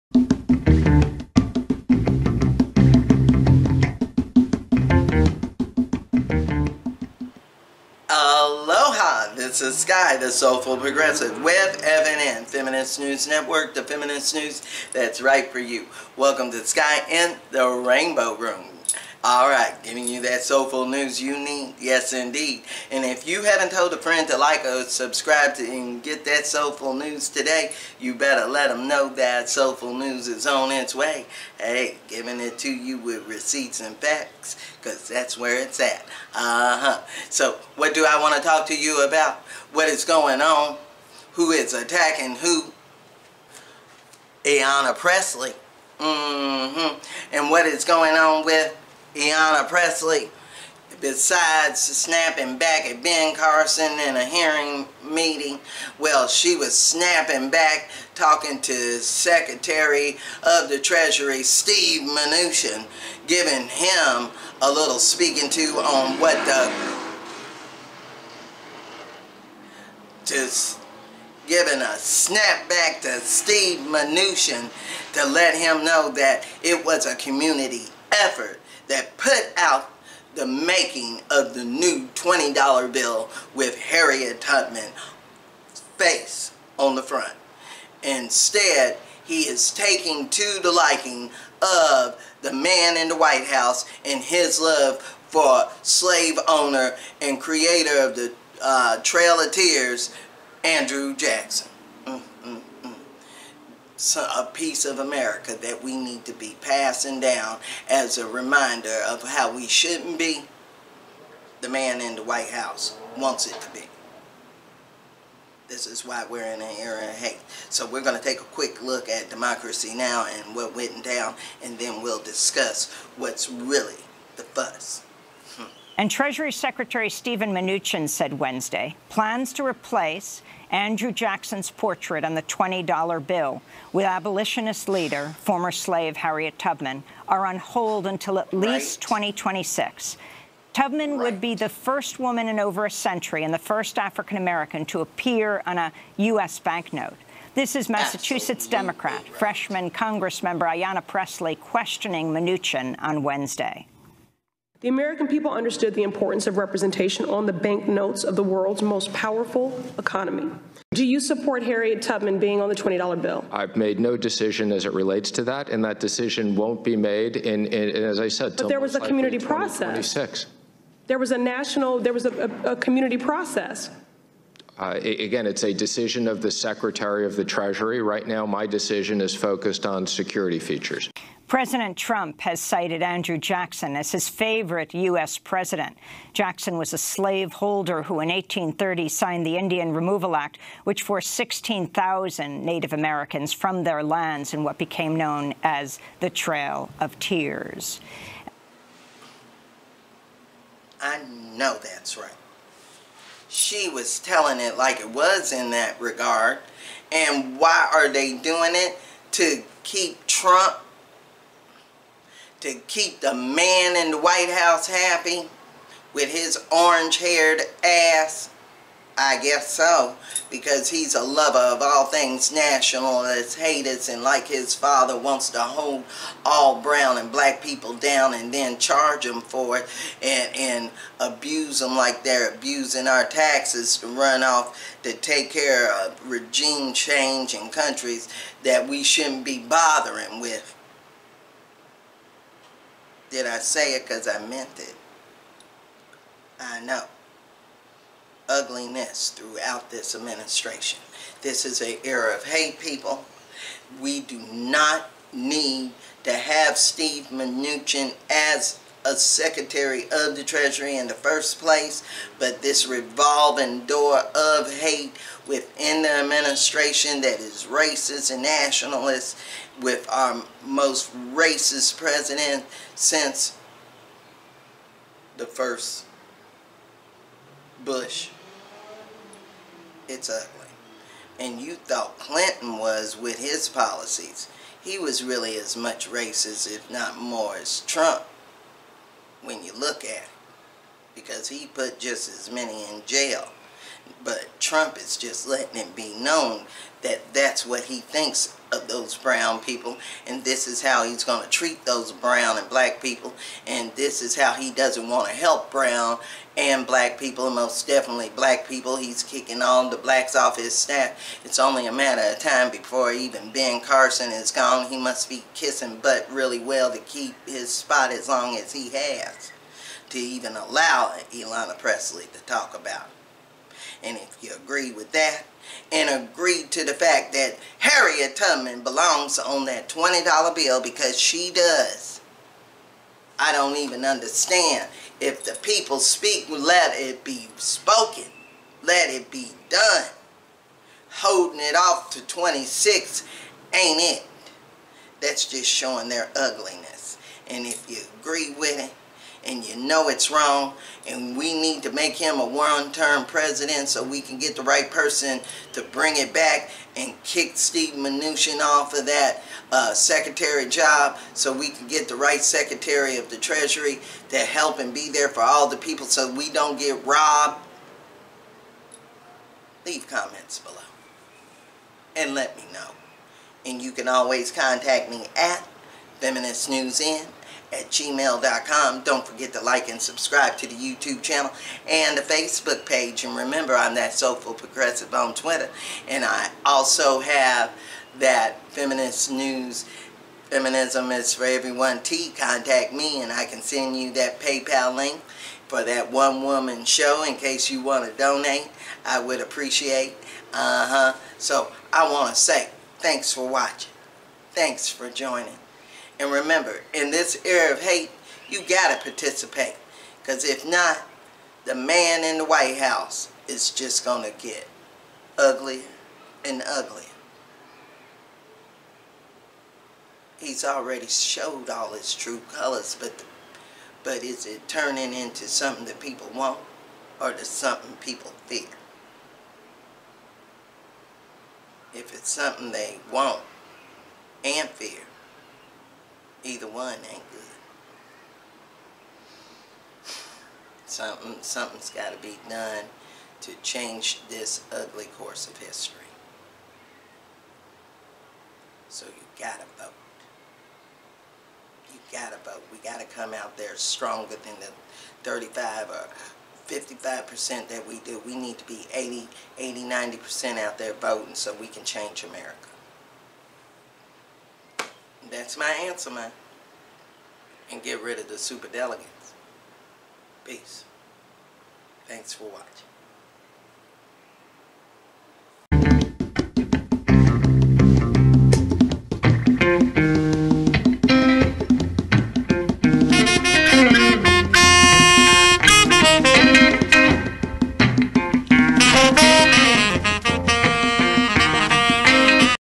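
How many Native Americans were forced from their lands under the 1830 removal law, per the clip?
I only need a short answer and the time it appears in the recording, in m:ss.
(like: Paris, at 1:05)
16,000, at 3:11.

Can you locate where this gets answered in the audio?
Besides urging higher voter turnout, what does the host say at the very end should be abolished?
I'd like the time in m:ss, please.
7:48.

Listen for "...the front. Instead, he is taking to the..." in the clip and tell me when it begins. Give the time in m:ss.
1:26.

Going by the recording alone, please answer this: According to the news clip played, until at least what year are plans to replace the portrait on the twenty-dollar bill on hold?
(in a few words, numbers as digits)
2026.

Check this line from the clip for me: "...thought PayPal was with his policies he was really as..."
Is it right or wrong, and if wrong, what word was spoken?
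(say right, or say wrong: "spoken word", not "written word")
wrong: "Clinton", not "PayPal".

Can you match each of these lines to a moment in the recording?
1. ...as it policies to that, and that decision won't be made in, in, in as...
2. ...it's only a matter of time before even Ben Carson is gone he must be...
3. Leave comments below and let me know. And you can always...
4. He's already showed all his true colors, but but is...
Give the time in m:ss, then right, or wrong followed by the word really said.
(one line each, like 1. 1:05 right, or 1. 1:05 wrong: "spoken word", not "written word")
1. 2:44 wrong: "relates", not "policies"
2. 5:11 right
3. 6:09 right
4. 7:00 right.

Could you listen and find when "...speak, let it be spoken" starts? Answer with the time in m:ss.
5:35.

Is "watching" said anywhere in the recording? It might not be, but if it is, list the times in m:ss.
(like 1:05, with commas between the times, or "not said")
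6:43, 7:52.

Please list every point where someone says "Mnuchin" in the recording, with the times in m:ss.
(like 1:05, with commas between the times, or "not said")
1:02, 1:13, 2:07, 2:32, 4:17, 5:57.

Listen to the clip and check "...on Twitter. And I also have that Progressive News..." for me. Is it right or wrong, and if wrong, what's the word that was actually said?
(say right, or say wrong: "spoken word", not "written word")
wrong: "Feminist", not "Progressive".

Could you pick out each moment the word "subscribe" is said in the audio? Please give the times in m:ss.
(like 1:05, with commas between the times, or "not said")
0:24, 6:20.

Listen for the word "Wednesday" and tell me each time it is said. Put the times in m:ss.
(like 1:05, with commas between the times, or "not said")
2:08, 2:33.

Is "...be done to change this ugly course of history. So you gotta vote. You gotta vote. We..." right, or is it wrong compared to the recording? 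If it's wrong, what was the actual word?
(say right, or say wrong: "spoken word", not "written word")
right.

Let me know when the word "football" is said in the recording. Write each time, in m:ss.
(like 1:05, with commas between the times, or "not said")
not said.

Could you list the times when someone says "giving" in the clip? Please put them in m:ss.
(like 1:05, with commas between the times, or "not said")
0:19, 0:32, 1:03, 1:11.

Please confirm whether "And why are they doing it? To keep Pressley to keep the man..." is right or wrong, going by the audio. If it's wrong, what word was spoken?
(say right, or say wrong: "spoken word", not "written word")
wrong: "Trump", not "Pressley".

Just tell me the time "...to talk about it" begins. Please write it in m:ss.
5:22.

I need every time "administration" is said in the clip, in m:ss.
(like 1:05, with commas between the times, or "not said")
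4:10, 4:26.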